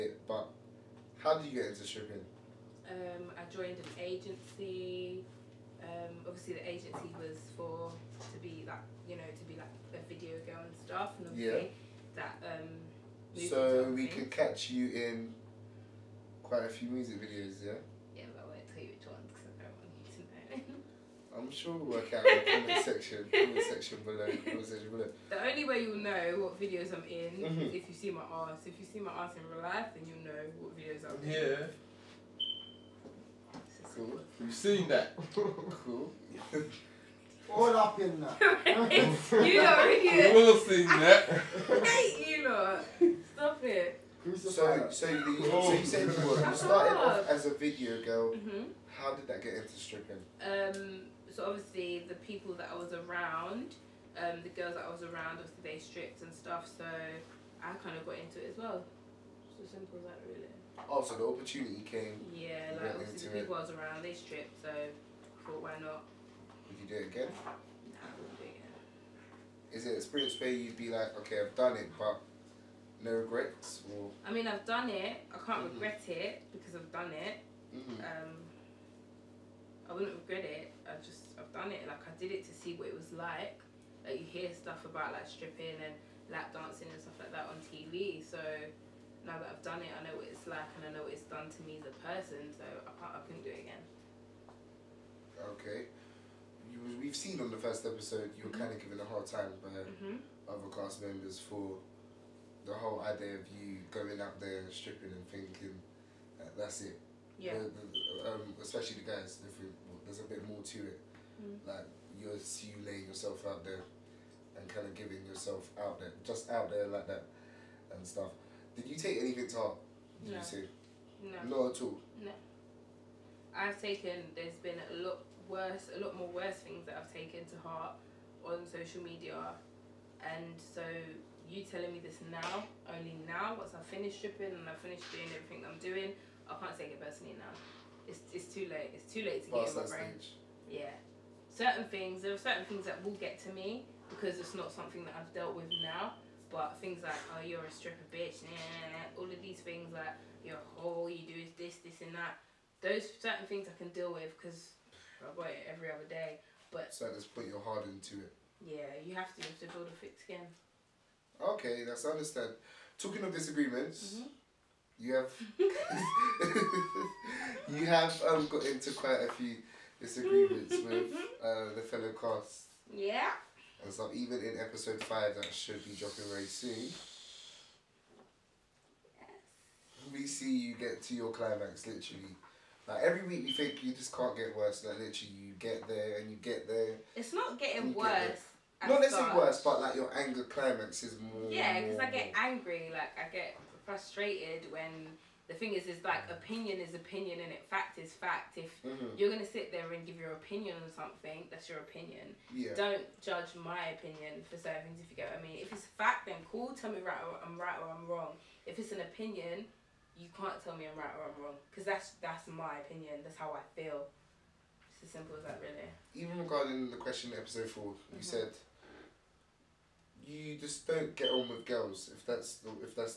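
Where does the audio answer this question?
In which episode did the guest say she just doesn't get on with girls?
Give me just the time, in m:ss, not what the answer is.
3:37.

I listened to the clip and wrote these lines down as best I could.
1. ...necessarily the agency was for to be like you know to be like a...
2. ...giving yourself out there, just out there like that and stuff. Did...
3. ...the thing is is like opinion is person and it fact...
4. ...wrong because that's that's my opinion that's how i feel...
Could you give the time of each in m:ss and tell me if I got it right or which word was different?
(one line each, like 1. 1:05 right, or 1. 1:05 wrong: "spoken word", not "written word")
1. 0:06 wrong: "obviously", not "necessarily"
2. 1:55 right
3. 3:15 wrong: "opinion", not "person"
4. 3:31 right.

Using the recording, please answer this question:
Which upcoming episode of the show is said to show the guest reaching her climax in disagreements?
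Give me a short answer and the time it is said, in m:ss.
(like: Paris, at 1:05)
5, at 2:54.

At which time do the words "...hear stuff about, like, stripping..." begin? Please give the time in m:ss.
1:24.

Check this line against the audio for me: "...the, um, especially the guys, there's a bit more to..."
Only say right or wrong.
right.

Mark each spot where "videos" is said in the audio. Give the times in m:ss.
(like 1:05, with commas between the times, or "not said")
0:10, 0:17, 0:26, 0:30, 0:47.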